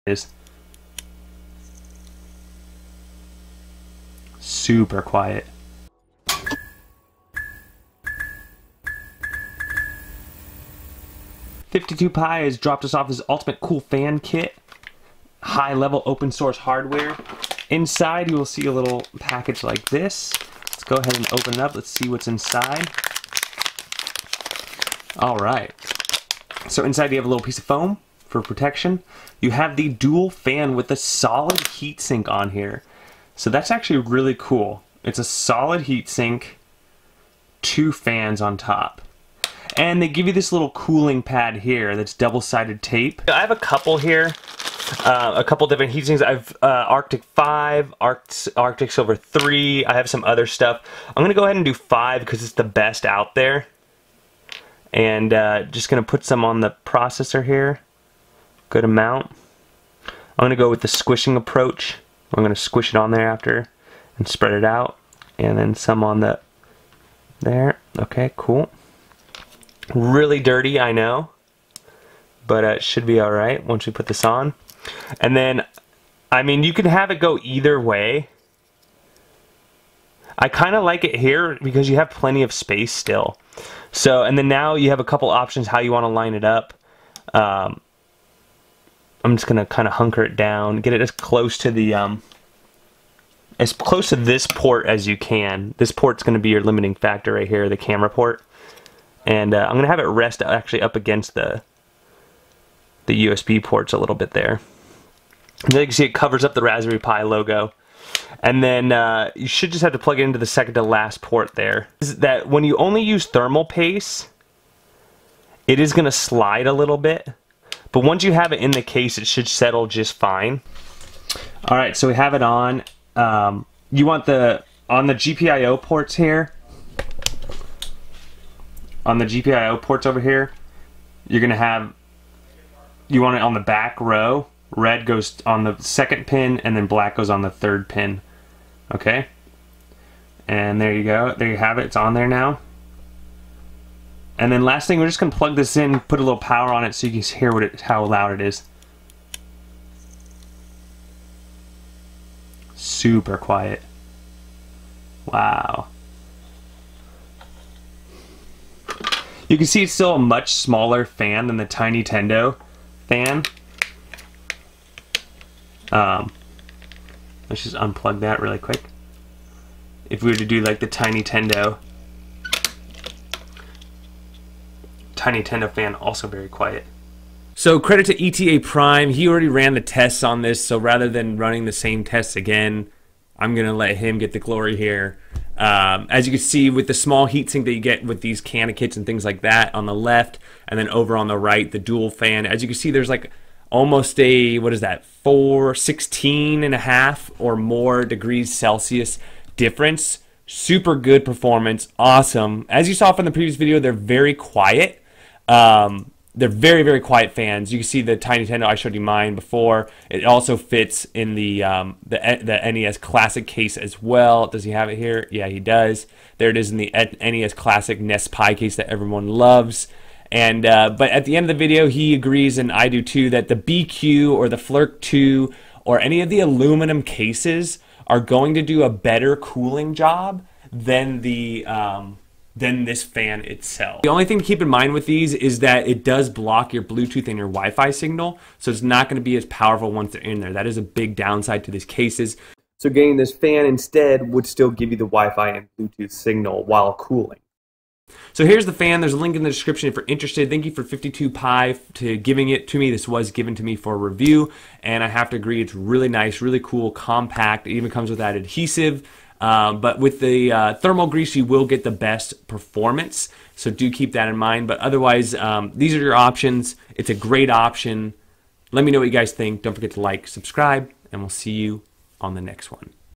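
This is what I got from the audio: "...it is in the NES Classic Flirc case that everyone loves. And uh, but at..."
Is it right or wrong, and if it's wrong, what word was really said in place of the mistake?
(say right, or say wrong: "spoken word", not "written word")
wrong: "NESPi", not "Flirc".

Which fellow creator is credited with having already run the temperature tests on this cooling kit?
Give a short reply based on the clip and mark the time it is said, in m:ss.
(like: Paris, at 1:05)
ETA Prime, at 2:58.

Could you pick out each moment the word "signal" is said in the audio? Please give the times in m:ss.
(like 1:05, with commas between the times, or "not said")
3:57, 4:06.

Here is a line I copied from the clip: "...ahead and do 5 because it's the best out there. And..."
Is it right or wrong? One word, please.
right.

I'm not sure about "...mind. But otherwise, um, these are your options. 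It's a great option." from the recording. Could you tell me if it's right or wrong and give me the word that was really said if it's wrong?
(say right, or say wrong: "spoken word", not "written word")
right.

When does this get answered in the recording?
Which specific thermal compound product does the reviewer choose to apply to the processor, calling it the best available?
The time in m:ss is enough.
0:46.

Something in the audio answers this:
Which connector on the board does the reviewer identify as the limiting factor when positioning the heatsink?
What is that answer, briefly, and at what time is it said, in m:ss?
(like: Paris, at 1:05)
the camera port, at 1:37.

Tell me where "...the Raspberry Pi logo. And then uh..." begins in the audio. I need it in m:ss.
1:46.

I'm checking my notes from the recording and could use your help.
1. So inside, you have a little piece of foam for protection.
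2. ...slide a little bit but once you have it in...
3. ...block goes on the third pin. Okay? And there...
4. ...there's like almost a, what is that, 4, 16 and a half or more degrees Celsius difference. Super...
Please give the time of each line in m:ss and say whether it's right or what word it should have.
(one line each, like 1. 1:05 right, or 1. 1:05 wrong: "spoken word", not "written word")
1. 0:26 right
2. 1:56 right
3. 2:16 wrong: "black", not "block"
4. 3:12 right.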